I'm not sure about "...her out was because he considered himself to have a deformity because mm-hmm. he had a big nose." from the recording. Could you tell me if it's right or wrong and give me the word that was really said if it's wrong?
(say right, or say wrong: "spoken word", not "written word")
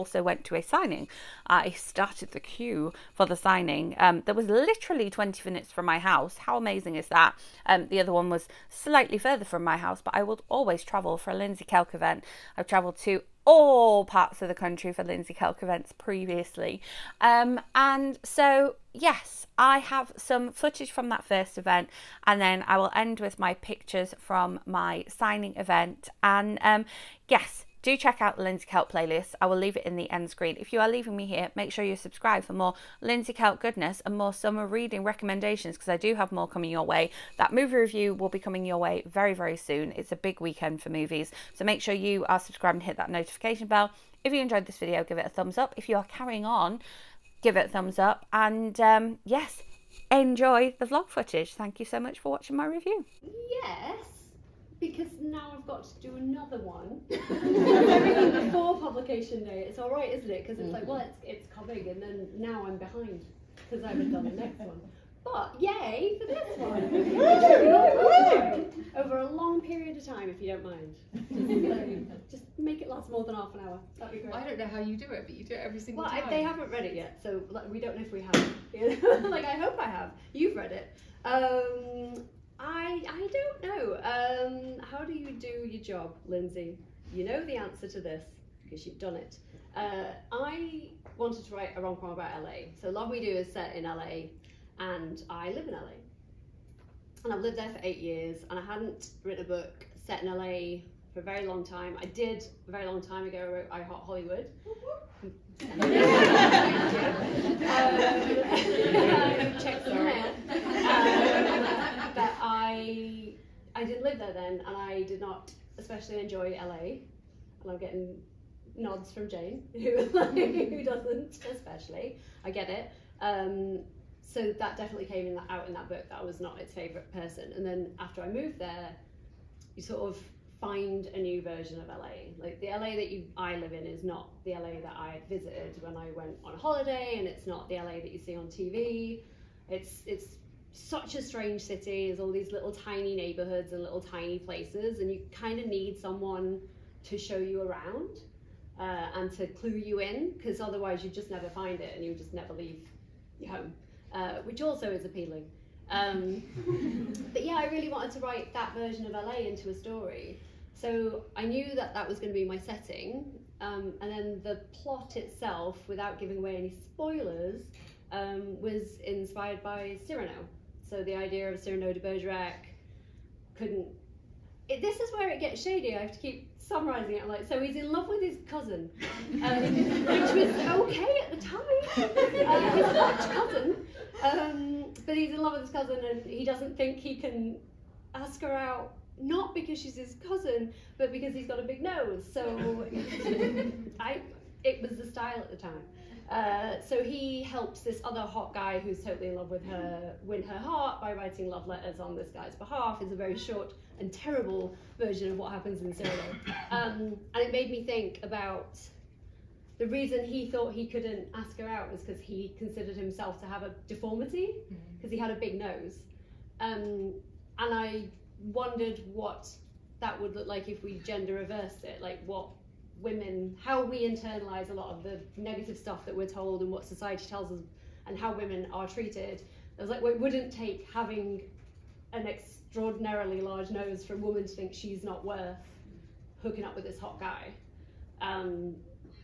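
right.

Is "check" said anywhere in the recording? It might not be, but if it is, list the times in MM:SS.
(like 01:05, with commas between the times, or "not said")
00:27, 01:49.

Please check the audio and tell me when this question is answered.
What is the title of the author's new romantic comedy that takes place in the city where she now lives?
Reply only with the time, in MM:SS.
01:32.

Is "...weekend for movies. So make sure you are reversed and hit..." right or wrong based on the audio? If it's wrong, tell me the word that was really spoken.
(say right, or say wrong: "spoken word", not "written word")
wrong: "subscribed", not "reversed".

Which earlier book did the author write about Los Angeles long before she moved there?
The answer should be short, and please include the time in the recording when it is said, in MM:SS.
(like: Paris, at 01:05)
I Heart Hollywood, at 01:43.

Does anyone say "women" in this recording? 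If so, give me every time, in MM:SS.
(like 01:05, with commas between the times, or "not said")
03:43, 03:48.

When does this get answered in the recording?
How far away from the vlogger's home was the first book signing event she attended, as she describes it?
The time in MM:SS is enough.
00:05.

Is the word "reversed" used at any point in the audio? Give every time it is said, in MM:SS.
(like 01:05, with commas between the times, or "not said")
03:41.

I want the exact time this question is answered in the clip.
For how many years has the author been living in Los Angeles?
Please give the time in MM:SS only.
01:37.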